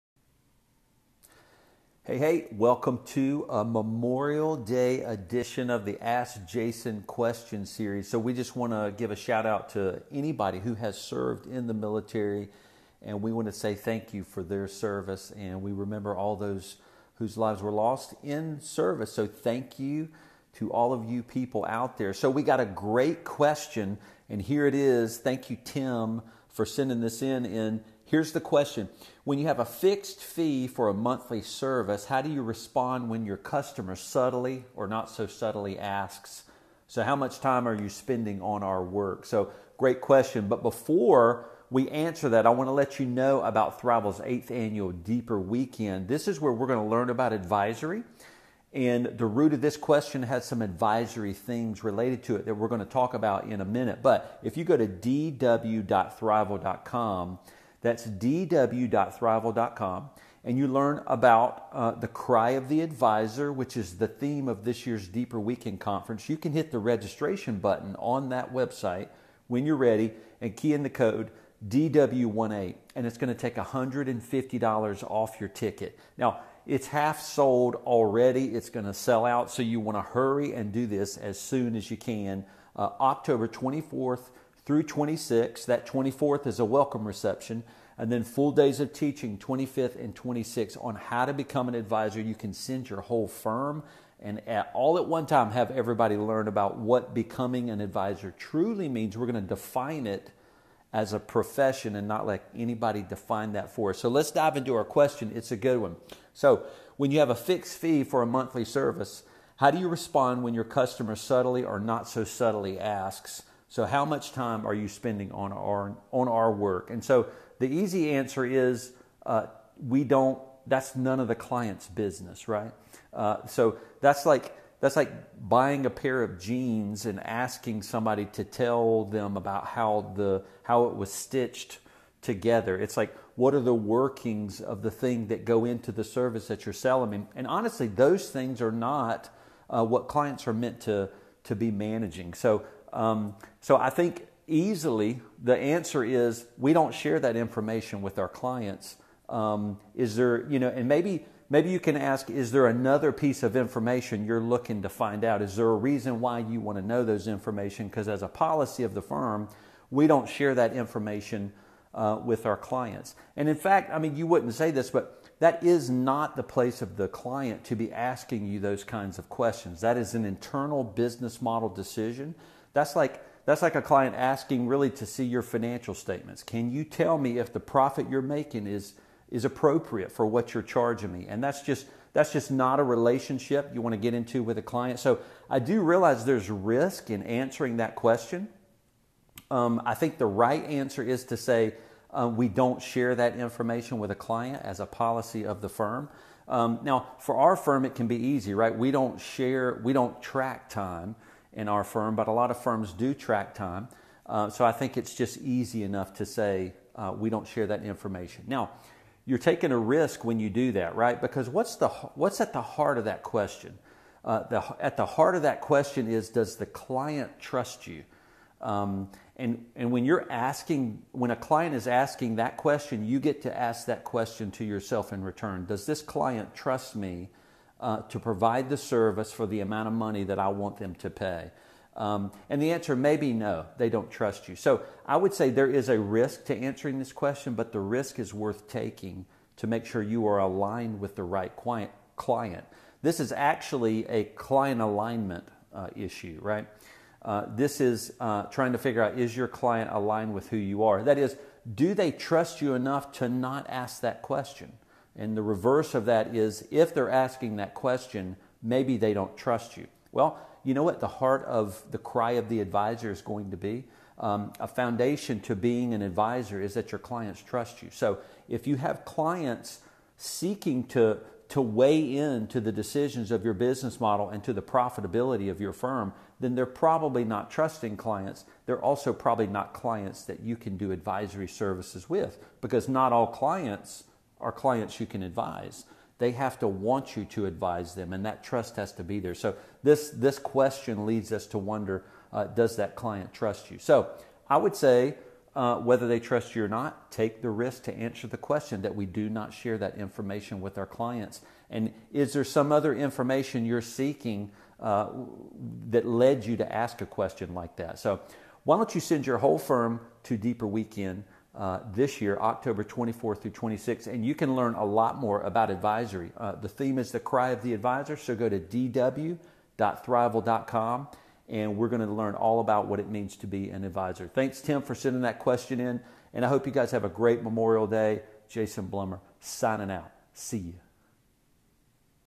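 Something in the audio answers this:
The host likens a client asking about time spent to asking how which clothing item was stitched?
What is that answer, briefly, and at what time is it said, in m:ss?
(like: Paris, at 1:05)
jeans, at 2:06.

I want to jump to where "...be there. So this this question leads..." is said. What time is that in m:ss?
4:49.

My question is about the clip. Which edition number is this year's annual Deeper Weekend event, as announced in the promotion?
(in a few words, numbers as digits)
eighth.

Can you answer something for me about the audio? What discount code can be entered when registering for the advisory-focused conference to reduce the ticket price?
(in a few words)
DW18.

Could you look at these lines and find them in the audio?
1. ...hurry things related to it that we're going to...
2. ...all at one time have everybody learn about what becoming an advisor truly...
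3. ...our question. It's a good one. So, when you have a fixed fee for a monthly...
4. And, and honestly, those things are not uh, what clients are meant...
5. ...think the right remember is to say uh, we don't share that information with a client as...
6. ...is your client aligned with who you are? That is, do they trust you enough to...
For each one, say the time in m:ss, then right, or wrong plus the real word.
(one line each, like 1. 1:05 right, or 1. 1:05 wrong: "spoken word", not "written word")
1. 0:50 wrong: "advisory", not "hurry"
2. 1:34 right
3. 1:44 right
4. 2:17 right
5. 3:09 wrong: "answer", not "remember"
6. 4:09 right.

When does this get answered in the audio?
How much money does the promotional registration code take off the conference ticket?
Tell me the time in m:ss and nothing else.
1:13.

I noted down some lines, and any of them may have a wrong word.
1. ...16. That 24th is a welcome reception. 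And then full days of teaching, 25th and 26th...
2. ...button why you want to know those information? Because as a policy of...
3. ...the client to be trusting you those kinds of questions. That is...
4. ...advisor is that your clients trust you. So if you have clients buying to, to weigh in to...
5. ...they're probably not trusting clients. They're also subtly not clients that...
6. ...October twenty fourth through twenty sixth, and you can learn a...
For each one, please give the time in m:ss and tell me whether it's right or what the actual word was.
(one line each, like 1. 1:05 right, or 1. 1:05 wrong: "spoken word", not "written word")
1. 1:24 wrong: "26", not "16"
2. 2:35 wrong: "reason", not "button"
3. 2:46 wrong: "asking", not "trusting"
4. 4:26 wrong: "seeking", not "buying"
5. 4:36 wrong: "probably", not "subtly"
6. 5:12 right.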